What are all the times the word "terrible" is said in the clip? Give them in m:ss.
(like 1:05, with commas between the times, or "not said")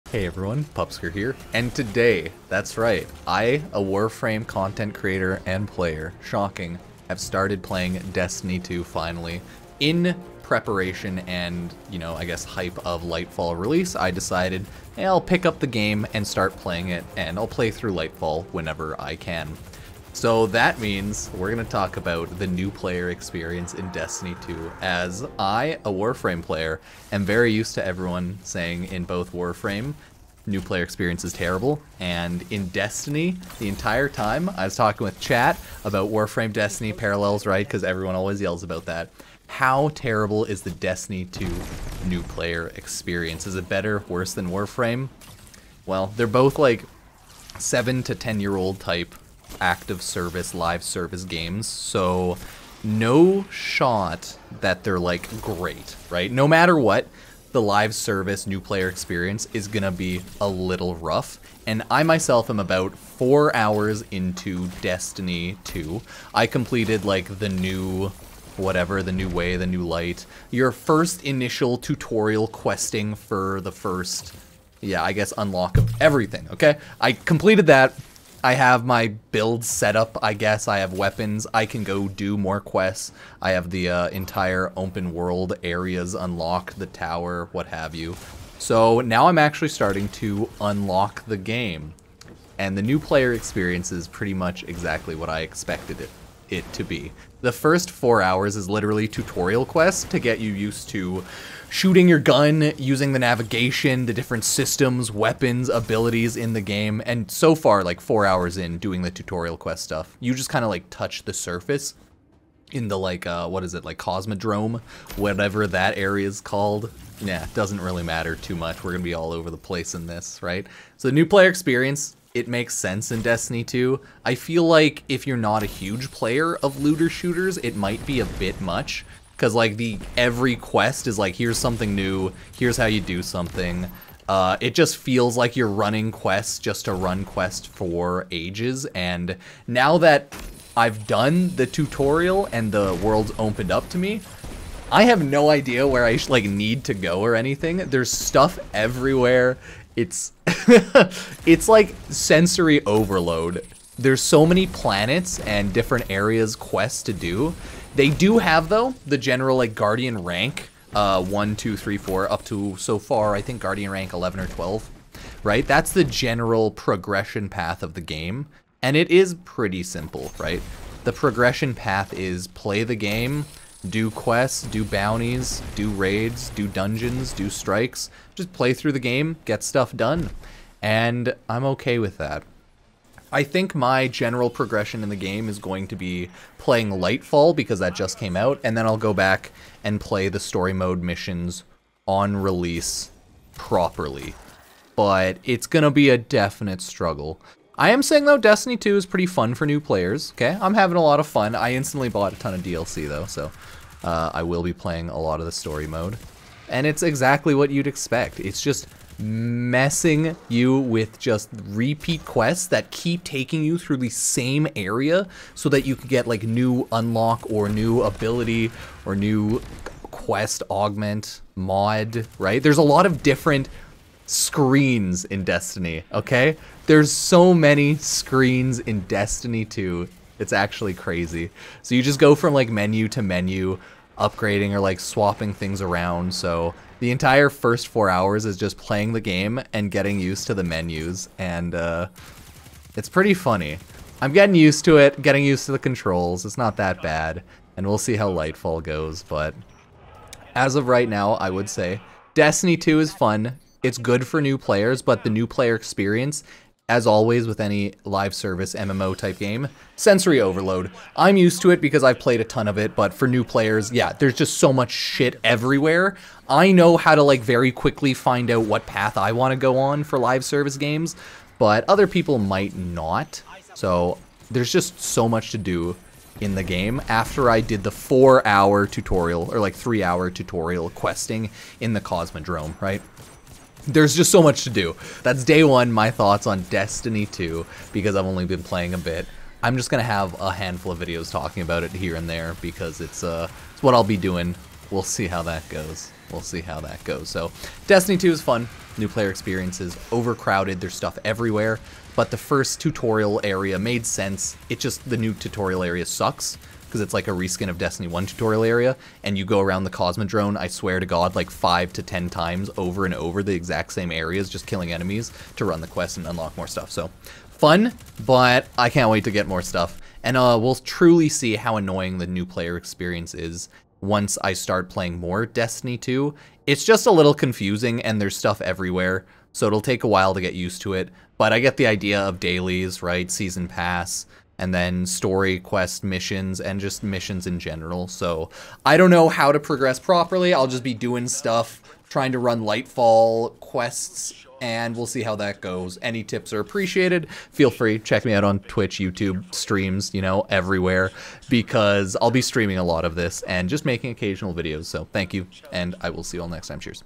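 0:31, 0:39.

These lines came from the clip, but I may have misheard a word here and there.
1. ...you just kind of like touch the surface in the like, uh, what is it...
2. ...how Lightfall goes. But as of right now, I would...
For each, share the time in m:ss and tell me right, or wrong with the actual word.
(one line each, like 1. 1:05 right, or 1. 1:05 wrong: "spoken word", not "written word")
1. 1:50 right
2. 4:08 right.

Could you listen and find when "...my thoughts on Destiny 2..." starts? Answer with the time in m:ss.
4:45.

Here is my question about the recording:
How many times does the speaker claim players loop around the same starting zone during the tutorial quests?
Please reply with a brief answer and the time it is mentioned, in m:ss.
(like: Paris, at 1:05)
5 to 10, at 5:11.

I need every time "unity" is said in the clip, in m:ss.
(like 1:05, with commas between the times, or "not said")
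not said.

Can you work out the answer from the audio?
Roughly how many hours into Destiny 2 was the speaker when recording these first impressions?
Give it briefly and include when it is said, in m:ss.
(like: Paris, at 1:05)
4, at 1:02.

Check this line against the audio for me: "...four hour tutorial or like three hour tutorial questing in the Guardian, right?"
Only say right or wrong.
wrong.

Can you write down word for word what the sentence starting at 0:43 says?
Is it better, worse than Warframe?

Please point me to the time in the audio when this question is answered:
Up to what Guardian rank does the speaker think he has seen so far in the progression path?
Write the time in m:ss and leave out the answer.
2:43.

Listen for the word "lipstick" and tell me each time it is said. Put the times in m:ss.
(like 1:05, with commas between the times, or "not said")
not said.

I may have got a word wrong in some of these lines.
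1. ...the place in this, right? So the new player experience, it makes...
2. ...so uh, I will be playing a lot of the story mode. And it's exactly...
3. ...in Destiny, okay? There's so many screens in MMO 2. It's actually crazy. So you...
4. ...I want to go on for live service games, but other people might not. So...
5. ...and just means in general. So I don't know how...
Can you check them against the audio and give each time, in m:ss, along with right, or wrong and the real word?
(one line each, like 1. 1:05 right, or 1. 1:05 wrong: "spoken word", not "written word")
1. 1:59 right
2. 3:23 right
3. 3:45 wrong: "Destiny", not "MMO"
4. 4:29 right
5. 5:36 wrong: "missions", not "means".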